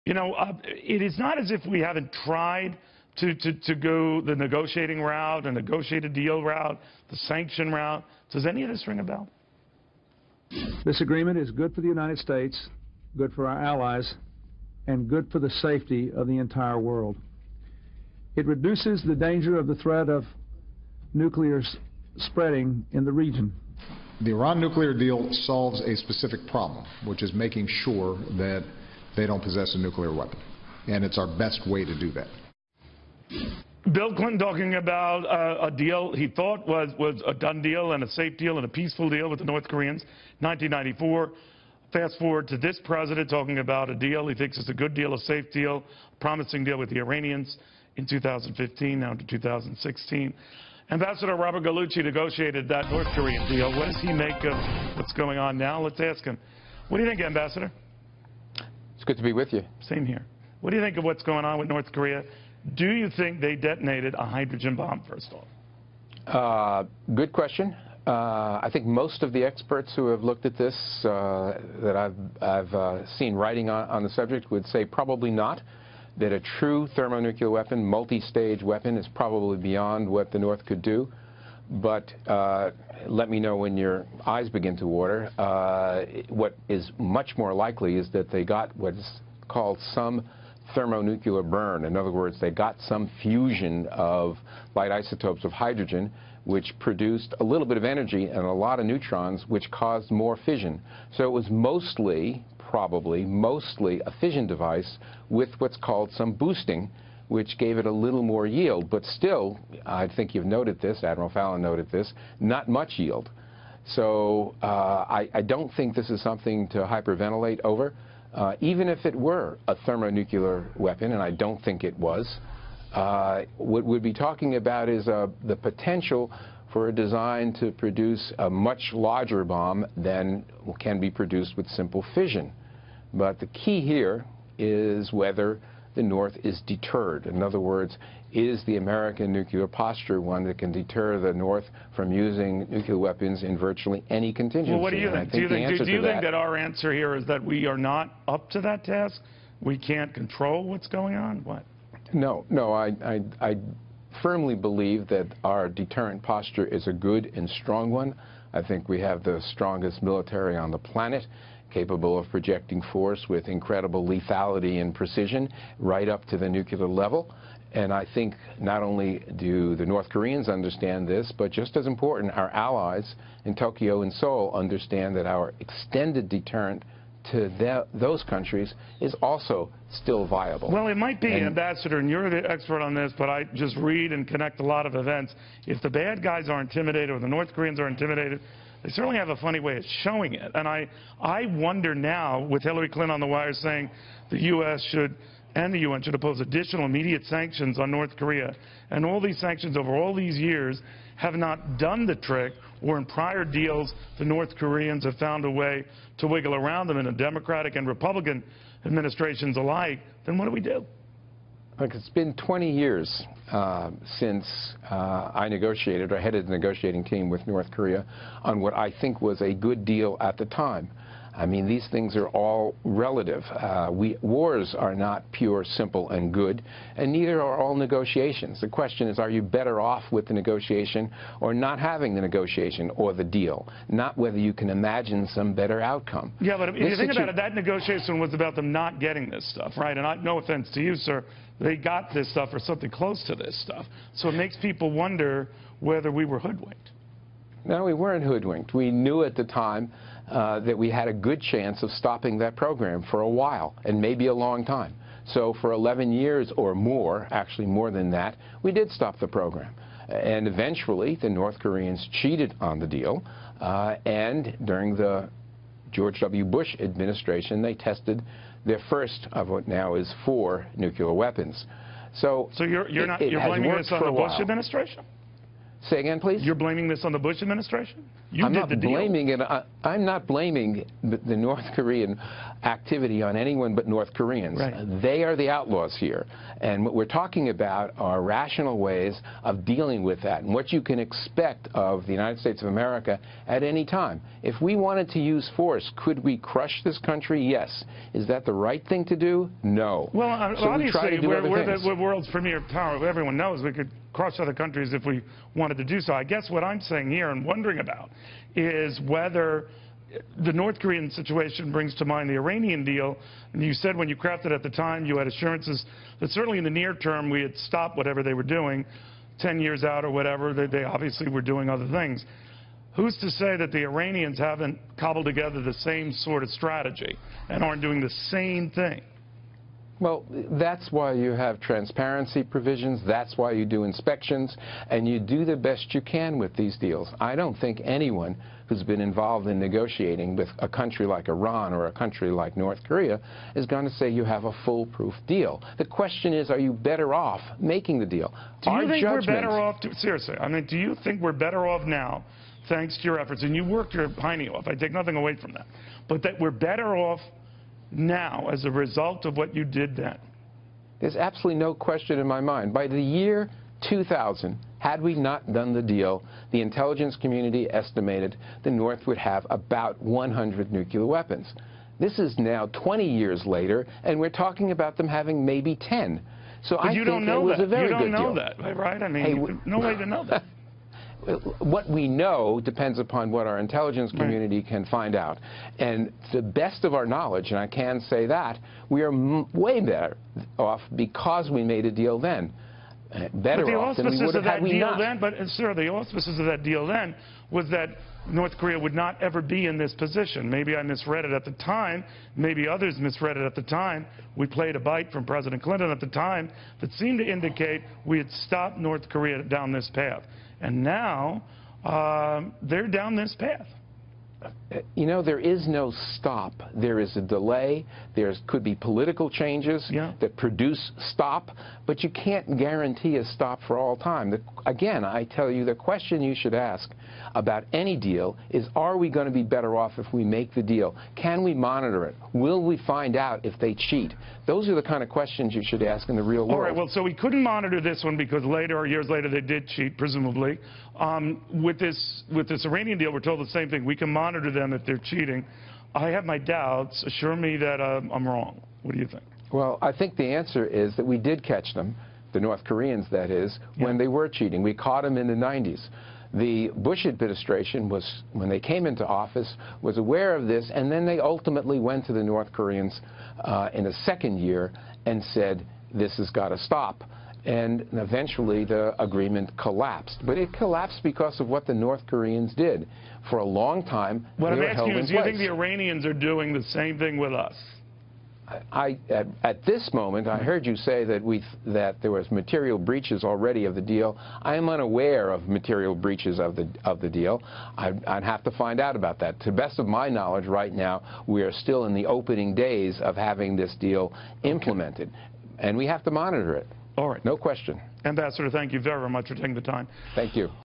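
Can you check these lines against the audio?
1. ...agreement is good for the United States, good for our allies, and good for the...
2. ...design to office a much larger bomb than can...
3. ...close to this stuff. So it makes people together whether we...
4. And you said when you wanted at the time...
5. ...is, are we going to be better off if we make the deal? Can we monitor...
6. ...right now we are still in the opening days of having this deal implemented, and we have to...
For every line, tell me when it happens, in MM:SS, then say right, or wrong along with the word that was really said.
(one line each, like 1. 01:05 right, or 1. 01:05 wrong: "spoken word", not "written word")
1. 00:11 right
2. 02:06 wrong: "produce", not "office"
3. 04:02 wrong: "wonder", not "together"
4. 05:13 wrong: "crafted", not "wanted"
5. 07:08 right
6. 08:10 right.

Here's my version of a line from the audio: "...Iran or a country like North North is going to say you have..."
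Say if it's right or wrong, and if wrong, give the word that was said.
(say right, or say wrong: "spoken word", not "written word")
wrong: "Korea", not "North".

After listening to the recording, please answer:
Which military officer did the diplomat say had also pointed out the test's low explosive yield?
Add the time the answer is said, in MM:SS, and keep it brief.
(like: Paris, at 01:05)
Admiral Fallon, at 01:51.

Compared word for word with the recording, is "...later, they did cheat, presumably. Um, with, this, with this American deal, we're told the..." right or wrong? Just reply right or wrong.
wrong.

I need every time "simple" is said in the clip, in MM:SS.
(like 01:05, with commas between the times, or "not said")
02:11, 03:45.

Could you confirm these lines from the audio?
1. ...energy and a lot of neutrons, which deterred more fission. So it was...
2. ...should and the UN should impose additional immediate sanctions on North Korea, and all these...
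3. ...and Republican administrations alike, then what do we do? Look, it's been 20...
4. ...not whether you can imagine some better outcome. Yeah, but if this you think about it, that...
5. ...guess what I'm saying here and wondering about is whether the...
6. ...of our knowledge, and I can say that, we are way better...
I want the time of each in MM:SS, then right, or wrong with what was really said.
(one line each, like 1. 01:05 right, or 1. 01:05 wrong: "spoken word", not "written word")
1. 01:37 wrong: "caused", not "deterred"
2. 03:14 right
3. 03:27 right
4. 03:53 right
5. 05:06 right
6. 06:26 right.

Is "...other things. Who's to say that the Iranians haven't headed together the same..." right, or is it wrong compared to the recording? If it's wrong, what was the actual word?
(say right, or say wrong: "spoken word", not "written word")
wrong: "cobbled", not "headed".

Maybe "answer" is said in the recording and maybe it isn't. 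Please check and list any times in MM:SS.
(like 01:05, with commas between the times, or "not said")
02:26, 07:30.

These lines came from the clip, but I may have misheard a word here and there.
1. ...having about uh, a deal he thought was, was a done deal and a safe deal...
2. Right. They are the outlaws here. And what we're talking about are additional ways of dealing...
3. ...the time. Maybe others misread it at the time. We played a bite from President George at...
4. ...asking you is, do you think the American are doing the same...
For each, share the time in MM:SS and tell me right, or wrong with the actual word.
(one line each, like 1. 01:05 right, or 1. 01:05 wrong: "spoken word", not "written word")
1. 00:34 wrong: "talking", not "having"
2. 04:44 wrong: "rational", not "additional"
3. 06:41 wrong: "Clinton", not "George"
4. 07:54 wrong: "Iranians", not "American".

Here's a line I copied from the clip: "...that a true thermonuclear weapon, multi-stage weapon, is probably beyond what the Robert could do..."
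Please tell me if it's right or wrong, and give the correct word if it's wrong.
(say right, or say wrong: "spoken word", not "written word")
wrong: "North", not "Robert".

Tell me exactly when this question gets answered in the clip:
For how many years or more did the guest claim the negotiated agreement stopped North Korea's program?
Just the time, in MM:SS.
04:15.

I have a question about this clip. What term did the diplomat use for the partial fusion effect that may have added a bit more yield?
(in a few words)
boosting.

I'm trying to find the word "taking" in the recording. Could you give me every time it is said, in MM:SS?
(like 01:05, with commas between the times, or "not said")
08:19.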